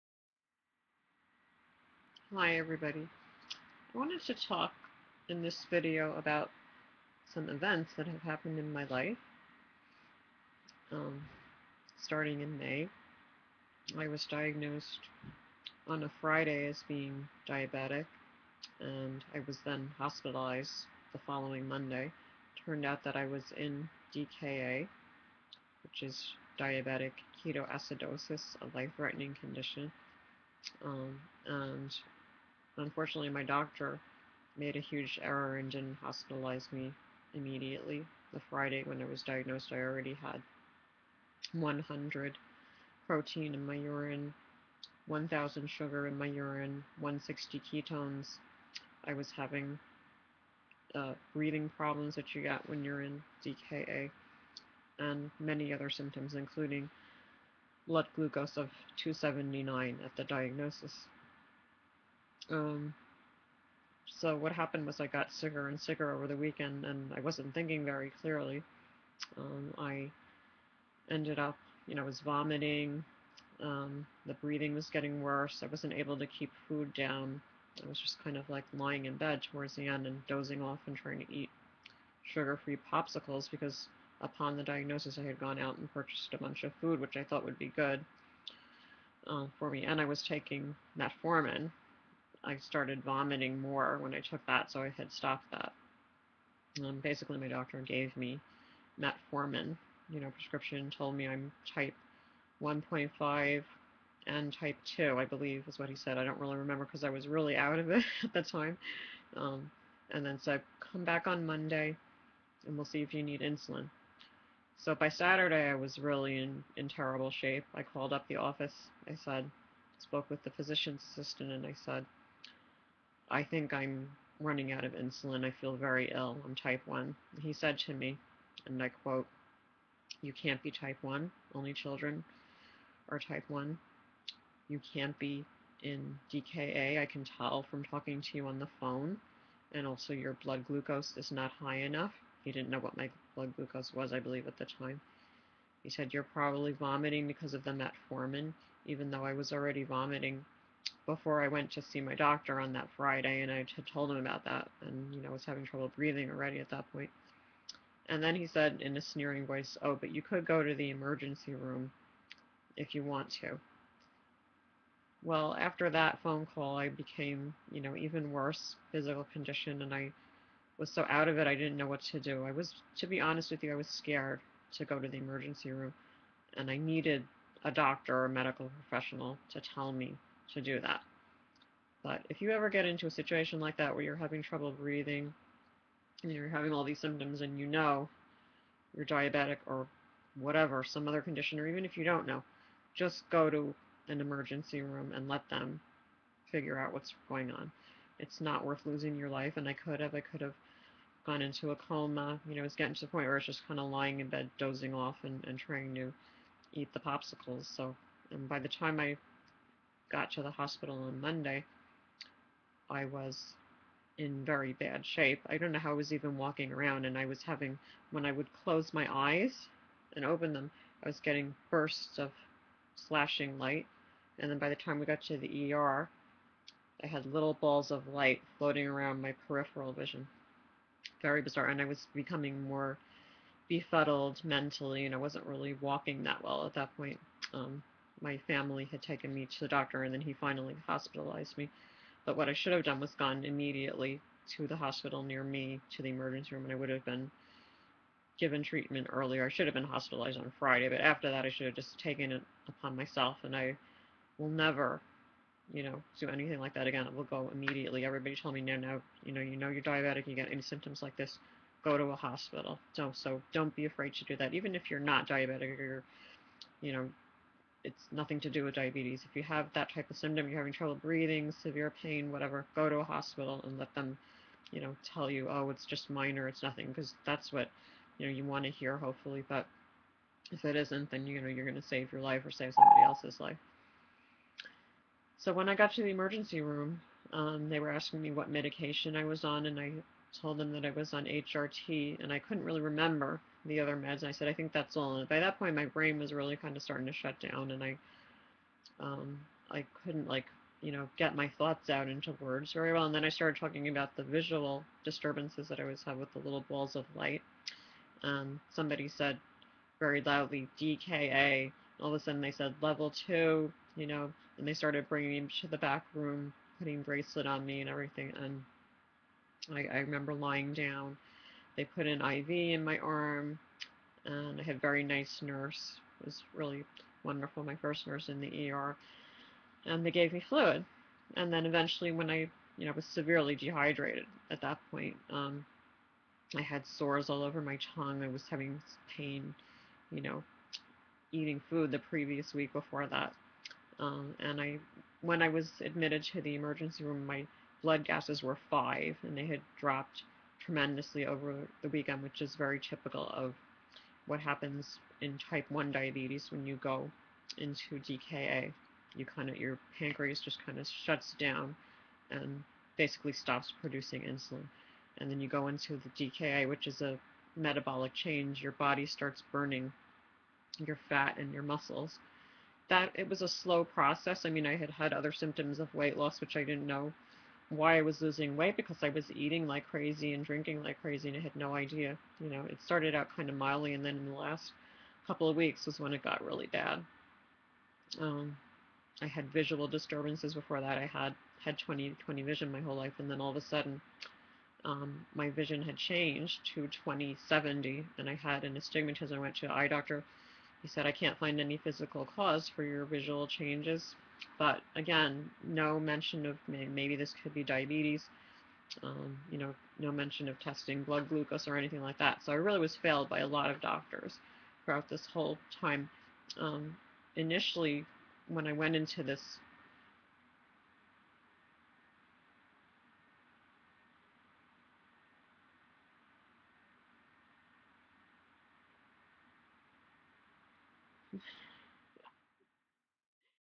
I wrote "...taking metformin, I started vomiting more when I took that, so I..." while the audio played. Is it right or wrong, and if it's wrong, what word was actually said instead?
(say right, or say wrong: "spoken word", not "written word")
right.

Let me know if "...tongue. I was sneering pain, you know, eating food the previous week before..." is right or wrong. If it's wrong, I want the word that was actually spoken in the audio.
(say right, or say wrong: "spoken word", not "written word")
wrong: "having", not "sneering".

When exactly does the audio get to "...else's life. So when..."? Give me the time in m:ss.
4:43.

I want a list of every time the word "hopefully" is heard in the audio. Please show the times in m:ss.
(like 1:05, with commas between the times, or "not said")
4:38.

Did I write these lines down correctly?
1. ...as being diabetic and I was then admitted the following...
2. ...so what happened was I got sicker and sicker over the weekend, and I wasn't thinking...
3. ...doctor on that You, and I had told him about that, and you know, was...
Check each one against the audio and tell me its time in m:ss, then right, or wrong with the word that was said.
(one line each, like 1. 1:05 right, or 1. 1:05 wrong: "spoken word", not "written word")
1. 0:16 wrong: "hospitalized", not "admitted"
2. 1:04 right
3. 2:32 wrong: "Friday", not "You".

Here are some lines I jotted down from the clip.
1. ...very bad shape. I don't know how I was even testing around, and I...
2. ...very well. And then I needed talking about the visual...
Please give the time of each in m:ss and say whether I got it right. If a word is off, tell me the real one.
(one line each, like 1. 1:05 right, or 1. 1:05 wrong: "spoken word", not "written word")
1. 3:34 wrong: "walking", not "testing"
2. 5:02 wrong: "started", not "needed".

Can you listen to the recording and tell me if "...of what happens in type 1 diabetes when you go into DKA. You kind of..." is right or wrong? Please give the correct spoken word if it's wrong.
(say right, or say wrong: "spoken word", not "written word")
right.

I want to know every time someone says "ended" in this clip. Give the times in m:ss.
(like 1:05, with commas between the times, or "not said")
1:11.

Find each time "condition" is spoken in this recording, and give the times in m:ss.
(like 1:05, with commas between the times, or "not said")
0:29, 2:49, 3:11.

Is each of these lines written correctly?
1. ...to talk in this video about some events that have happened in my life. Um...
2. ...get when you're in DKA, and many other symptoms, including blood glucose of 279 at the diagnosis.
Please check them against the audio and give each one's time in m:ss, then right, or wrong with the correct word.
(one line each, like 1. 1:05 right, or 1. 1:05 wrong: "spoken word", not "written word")
1. 0:04 right
2. 0:52 right.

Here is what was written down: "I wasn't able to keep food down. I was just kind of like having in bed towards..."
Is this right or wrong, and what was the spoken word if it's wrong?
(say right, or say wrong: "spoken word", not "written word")
wrong: "lying", not "having".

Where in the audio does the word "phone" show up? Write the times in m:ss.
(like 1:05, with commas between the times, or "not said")
2:18, 2:46.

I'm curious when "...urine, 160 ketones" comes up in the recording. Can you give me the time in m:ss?
0:46.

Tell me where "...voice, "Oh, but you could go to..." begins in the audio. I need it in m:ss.
2:39.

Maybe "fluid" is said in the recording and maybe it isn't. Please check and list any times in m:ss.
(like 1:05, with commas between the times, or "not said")
5:30.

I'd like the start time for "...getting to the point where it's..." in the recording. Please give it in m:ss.
3:22.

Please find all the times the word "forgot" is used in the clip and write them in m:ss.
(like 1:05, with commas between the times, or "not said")
not said.